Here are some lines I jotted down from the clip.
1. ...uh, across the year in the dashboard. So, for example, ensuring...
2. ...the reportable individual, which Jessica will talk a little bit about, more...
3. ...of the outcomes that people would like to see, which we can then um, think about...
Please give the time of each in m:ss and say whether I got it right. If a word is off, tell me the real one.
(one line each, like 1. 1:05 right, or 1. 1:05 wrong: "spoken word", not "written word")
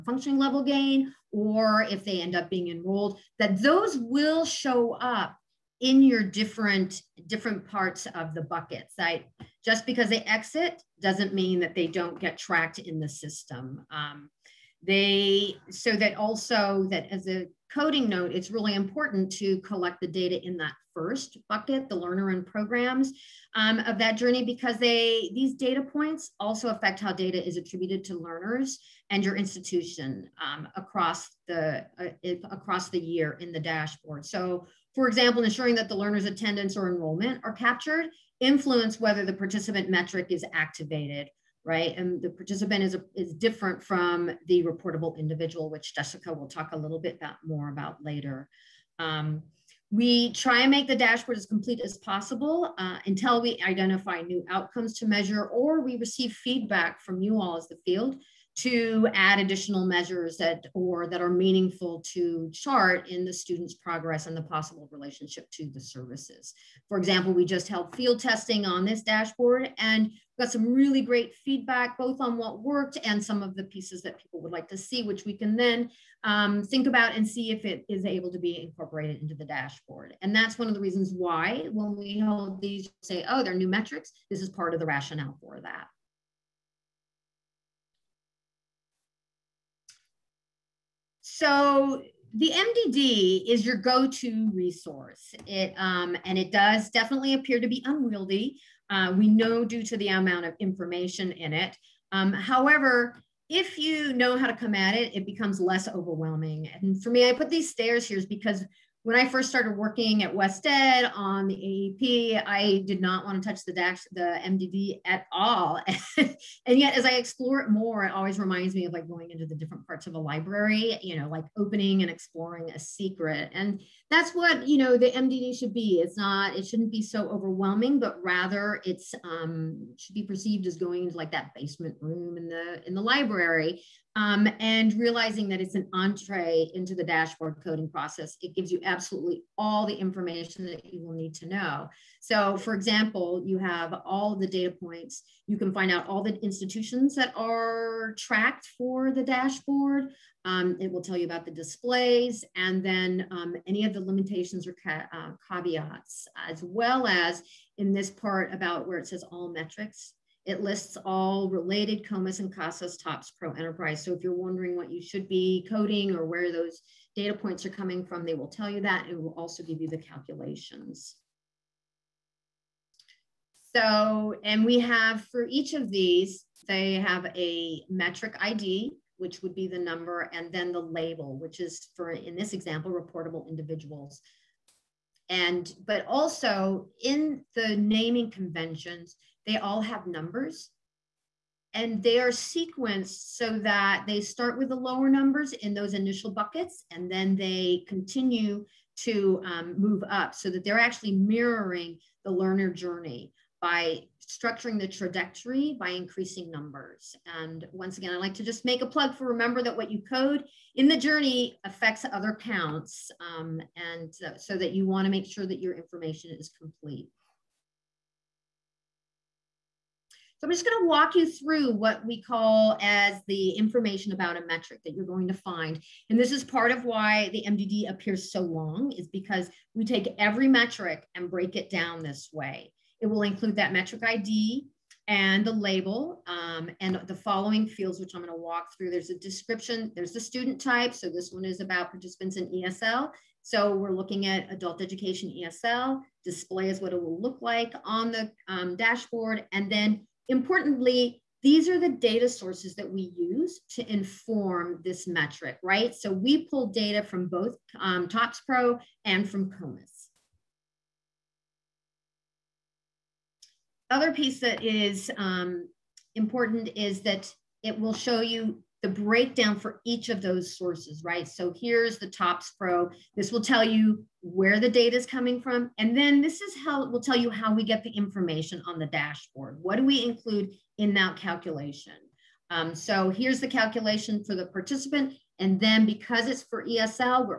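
1. 0:31 right
2. 0:44 right
3. 1:13 wrong: "pieces", not "outcomes".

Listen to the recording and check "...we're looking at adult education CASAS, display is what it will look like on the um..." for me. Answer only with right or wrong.
wrong.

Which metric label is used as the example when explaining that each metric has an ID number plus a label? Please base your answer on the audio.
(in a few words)
reportable individuals.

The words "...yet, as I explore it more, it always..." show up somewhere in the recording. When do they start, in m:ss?
1:56.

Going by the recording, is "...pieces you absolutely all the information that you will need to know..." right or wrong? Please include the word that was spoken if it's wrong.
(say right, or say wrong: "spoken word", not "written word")
wrong: "gives", not "pieces".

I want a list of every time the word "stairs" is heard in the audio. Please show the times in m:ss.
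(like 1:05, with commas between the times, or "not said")
1:47.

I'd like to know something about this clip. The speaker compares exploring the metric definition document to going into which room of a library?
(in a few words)
basement room.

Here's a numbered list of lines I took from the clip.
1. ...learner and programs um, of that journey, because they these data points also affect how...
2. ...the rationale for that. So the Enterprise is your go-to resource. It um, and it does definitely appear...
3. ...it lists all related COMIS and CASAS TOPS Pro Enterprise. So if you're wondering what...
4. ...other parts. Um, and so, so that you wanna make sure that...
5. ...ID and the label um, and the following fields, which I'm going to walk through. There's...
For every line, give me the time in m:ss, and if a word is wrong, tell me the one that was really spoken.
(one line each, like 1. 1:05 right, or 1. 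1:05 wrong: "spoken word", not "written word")
1. 0:21 right
2. 1:24 wrong: "MDD", not "Enterprise"
3. 2:40 right
4. 3:32 wrong: "counts", not "parts"
5. 3:54 right.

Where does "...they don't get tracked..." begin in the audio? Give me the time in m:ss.
0:11.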